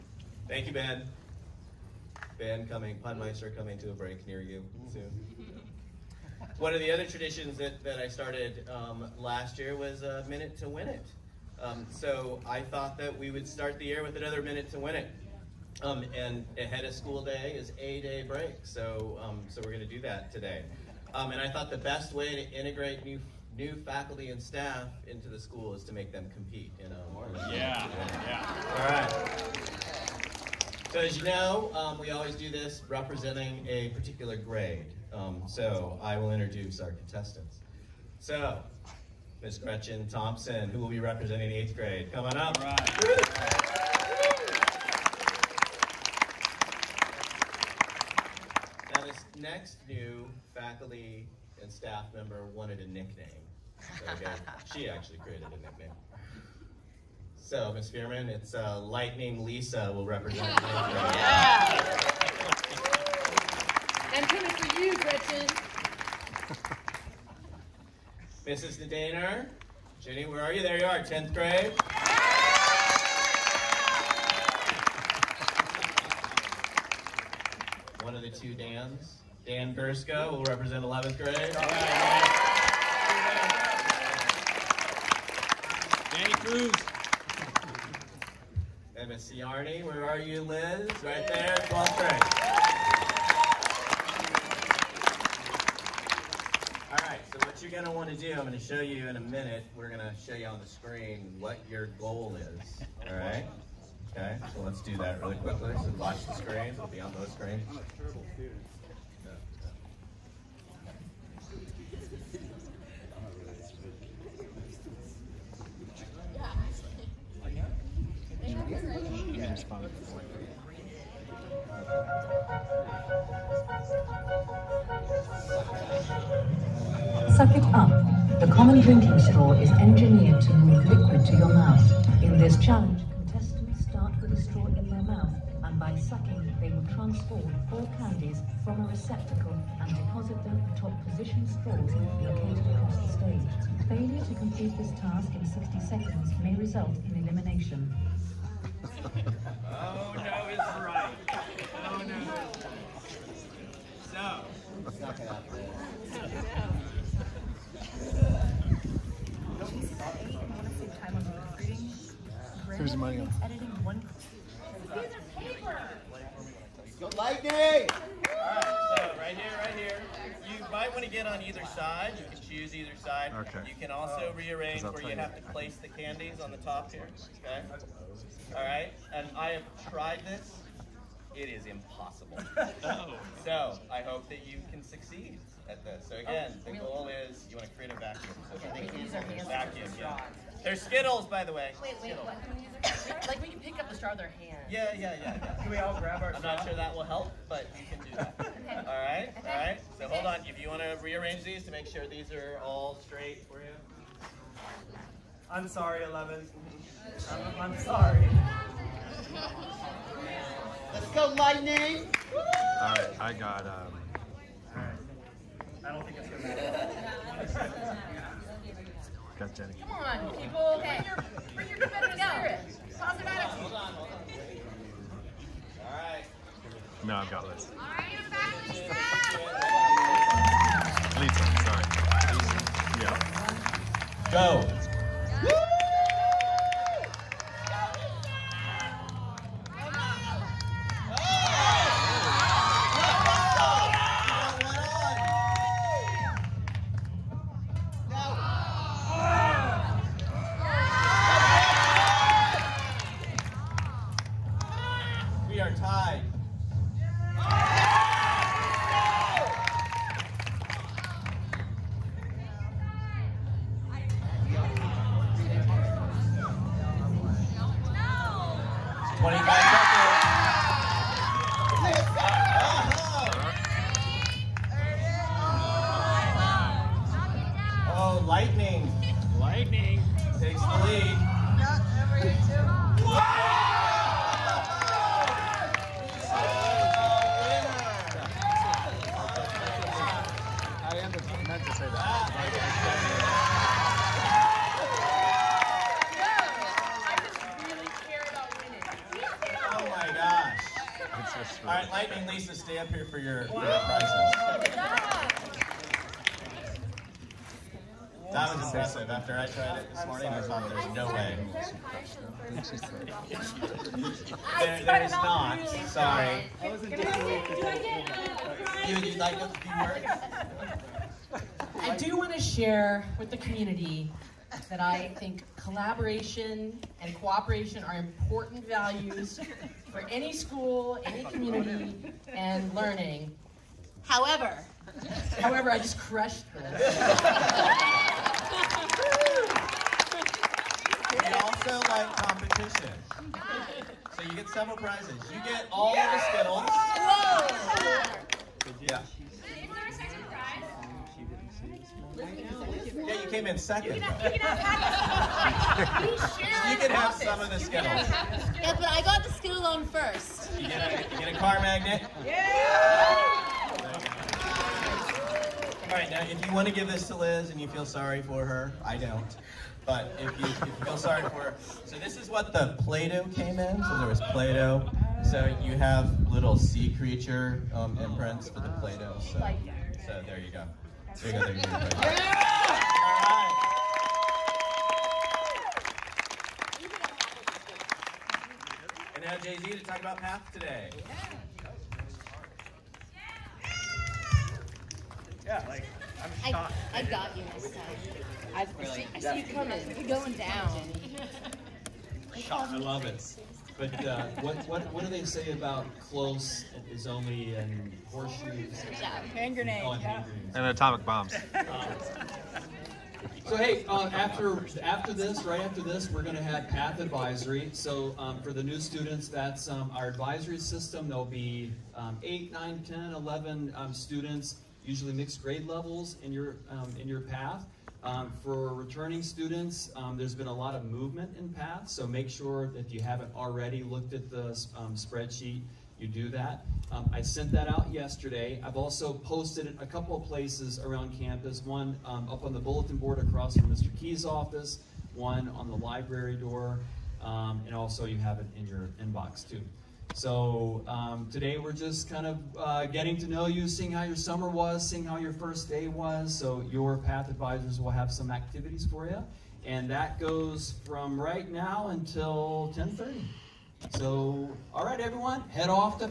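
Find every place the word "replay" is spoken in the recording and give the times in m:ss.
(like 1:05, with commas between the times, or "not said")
not said.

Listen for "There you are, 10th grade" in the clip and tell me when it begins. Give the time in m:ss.
1:10.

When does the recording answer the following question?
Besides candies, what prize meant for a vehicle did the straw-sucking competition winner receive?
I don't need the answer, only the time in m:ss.
6:01.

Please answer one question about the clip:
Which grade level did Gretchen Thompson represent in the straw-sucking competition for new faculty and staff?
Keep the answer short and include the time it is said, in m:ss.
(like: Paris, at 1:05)
eighth grade, at 0:41.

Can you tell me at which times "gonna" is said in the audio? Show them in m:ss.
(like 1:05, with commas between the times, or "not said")
3:36.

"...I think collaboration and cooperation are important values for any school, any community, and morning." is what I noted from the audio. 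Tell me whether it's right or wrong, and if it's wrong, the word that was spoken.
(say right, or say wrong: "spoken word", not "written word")
wrong: "learning", not "morning".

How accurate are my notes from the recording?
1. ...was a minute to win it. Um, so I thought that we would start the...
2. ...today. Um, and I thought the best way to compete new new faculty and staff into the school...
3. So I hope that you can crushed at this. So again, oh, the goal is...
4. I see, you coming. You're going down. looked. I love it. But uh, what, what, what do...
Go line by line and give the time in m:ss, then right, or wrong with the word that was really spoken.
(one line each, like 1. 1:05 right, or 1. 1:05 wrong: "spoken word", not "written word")
1. 0:09 right
2. 0:20 wrong: "integrate", not "compete"
3. 3:03 wrong: "succeed", not "crushed"
4. 6:39 wrong: "shocked", not "looked".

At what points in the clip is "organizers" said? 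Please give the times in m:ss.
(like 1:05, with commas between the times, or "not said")
not said.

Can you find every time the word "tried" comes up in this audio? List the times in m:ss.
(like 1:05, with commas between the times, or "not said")
2:59, 5:09.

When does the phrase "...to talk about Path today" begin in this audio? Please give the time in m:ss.
6:29.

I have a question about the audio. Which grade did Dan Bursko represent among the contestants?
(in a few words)
11th grade.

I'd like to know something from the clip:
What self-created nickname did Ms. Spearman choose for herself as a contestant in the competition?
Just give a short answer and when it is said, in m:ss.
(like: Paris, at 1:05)
Lightning Lisa, at 0:58.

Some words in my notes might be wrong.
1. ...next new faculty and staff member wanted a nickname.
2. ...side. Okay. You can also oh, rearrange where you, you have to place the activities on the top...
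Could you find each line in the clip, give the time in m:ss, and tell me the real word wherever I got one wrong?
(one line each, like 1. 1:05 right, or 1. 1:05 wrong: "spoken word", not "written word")
1. 0:49 right
2. 2:53 wrong: "candies", not "activities".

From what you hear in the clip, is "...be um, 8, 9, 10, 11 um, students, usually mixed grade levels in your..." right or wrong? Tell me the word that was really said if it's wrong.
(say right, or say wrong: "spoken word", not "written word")
right.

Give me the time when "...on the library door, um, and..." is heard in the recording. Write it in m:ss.
7:25.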